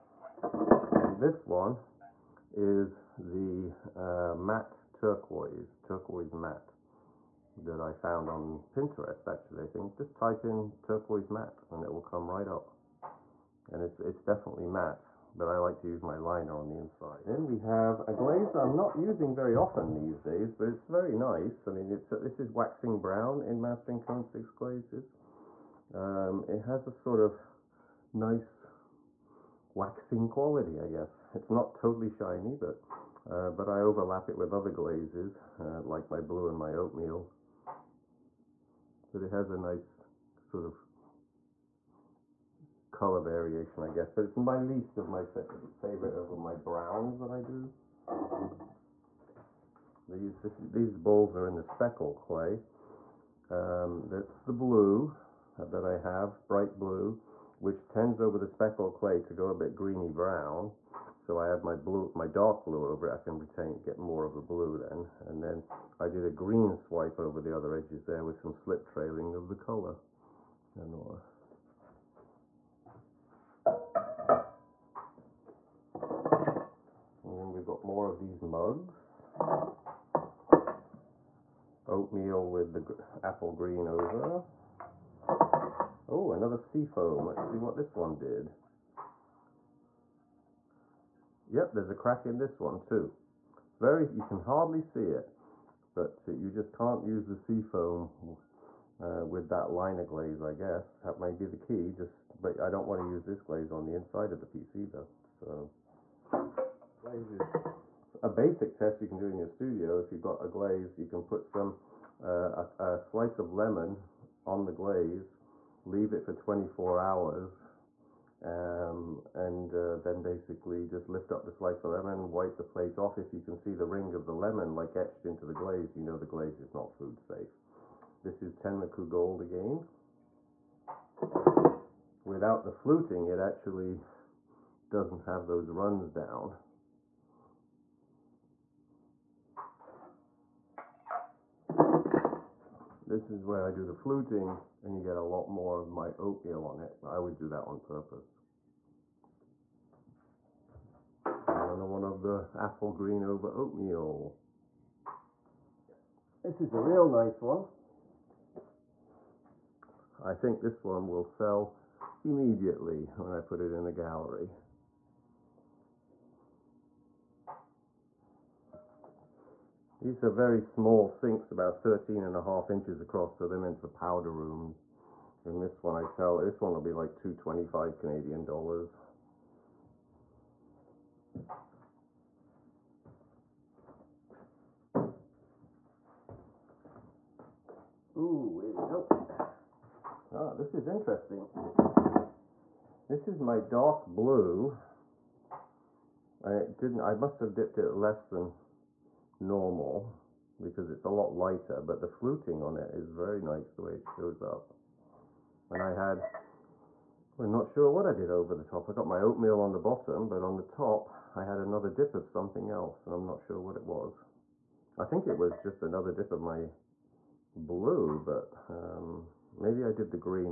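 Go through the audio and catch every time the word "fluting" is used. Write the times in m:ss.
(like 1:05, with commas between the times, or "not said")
2:12, 2:23, 3:22.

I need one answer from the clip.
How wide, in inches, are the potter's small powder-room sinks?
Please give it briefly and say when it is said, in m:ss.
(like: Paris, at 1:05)
13.5 inches, at 2:51.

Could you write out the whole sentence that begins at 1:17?
And then we've got more of these mugs.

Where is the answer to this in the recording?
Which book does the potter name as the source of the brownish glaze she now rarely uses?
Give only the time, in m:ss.
0:23.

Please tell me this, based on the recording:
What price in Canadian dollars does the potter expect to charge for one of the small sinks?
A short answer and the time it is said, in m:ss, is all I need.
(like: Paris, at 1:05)
225, at 2:57.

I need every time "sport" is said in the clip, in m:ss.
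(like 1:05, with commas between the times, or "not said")
not said.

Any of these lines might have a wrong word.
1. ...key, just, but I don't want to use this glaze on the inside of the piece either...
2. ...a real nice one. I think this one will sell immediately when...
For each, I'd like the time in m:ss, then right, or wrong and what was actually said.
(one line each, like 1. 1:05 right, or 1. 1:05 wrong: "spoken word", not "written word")
1. 1:41 right
2. 2:36 right.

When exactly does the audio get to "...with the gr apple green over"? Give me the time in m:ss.
1:22.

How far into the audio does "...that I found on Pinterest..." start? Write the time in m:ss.
0:07.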